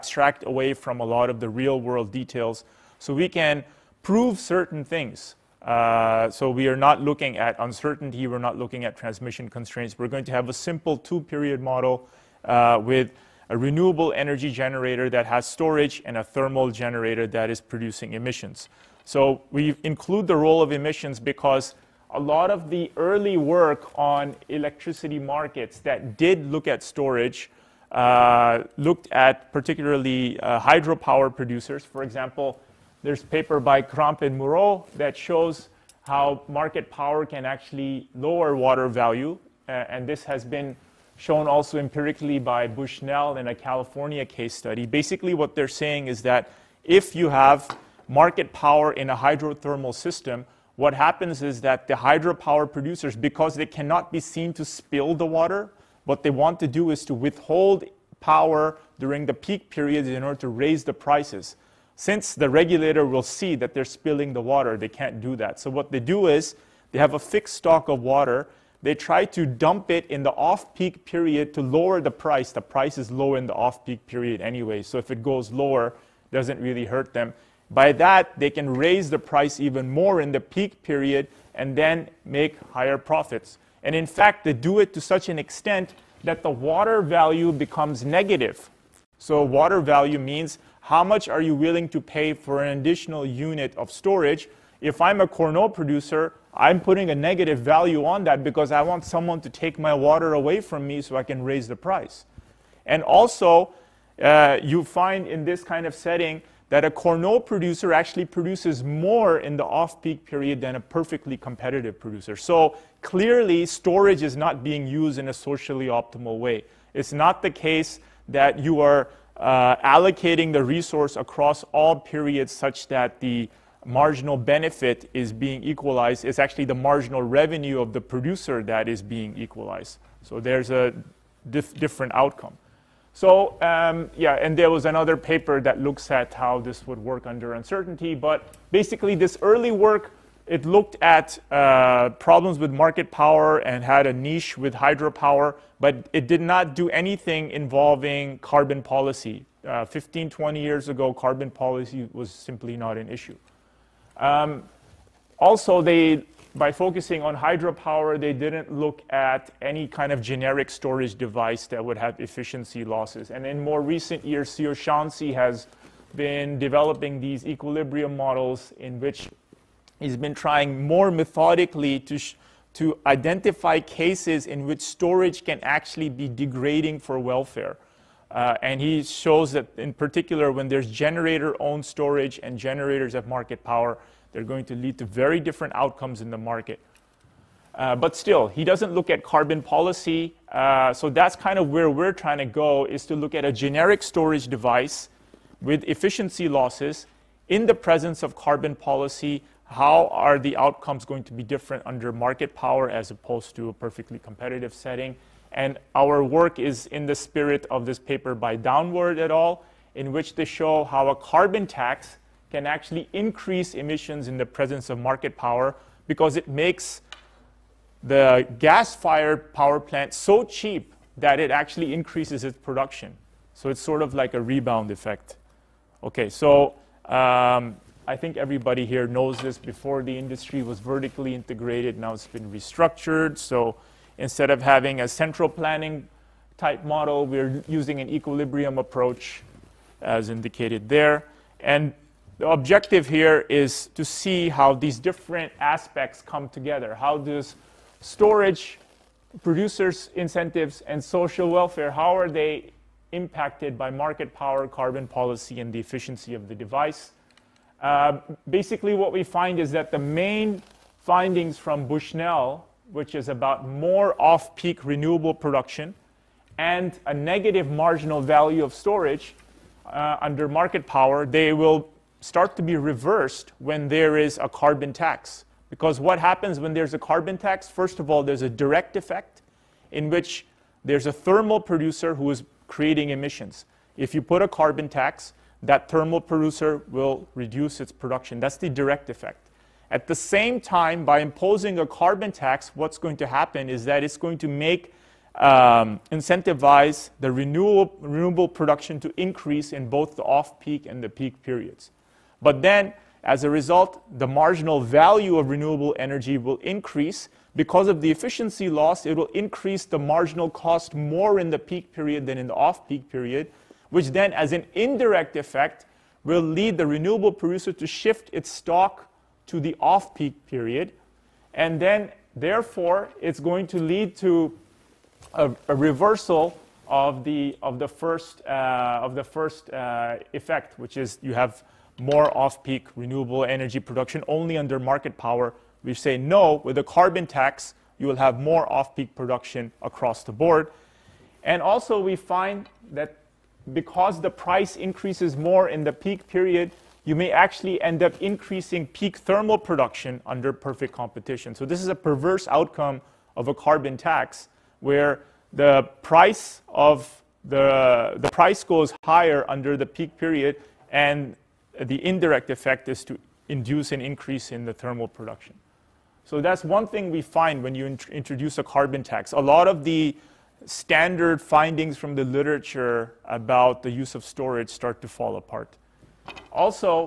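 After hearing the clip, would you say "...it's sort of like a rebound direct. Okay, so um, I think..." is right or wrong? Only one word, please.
wrong.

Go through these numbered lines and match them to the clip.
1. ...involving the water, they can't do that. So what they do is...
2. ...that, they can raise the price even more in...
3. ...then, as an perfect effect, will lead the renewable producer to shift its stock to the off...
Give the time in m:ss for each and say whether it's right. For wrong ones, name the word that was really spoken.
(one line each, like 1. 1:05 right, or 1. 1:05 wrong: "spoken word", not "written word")
1. 1:03 wrong: "spilling", not "involving"
2. 1:17 right
3. 5:14 wrong: "indirect", not "perfect".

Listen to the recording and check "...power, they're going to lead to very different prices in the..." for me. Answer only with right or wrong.
wrong.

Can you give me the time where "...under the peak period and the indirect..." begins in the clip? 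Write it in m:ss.
5:59.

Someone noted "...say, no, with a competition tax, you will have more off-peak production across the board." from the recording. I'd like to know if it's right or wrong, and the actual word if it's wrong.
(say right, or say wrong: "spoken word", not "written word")
wrong: "carbon", not "competition".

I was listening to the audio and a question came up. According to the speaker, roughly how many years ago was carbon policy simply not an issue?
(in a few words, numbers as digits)
15 to 20 years.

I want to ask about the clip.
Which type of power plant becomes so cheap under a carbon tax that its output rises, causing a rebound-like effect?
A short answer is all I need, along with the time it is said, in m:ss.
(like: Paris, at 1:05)
gas-fired power plant, at 3:38.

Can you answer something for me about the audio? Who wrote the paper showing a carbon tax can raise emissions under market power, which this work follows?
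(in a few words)
Downward et al.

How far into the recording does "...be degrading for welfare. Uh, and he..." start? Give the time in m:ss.
2:56.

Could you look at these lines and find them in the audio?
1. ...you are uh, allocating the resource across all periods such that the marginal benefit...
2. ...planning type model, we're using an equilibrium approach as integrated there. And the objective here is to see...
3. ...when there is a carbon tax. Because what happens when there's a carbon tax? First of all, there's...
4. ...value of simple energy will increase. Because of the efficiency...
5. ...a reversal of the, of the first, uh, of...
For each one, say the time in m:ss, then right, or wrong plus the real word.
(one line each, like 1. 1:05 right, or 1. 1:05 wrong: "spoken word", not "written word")
1. 1:58 right
2. 3:55 wrong: "indicated", not "integrated"
3. 4:33 right
4. 5:04 wrong: "renewable", not "simple"
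5. 5:25 right.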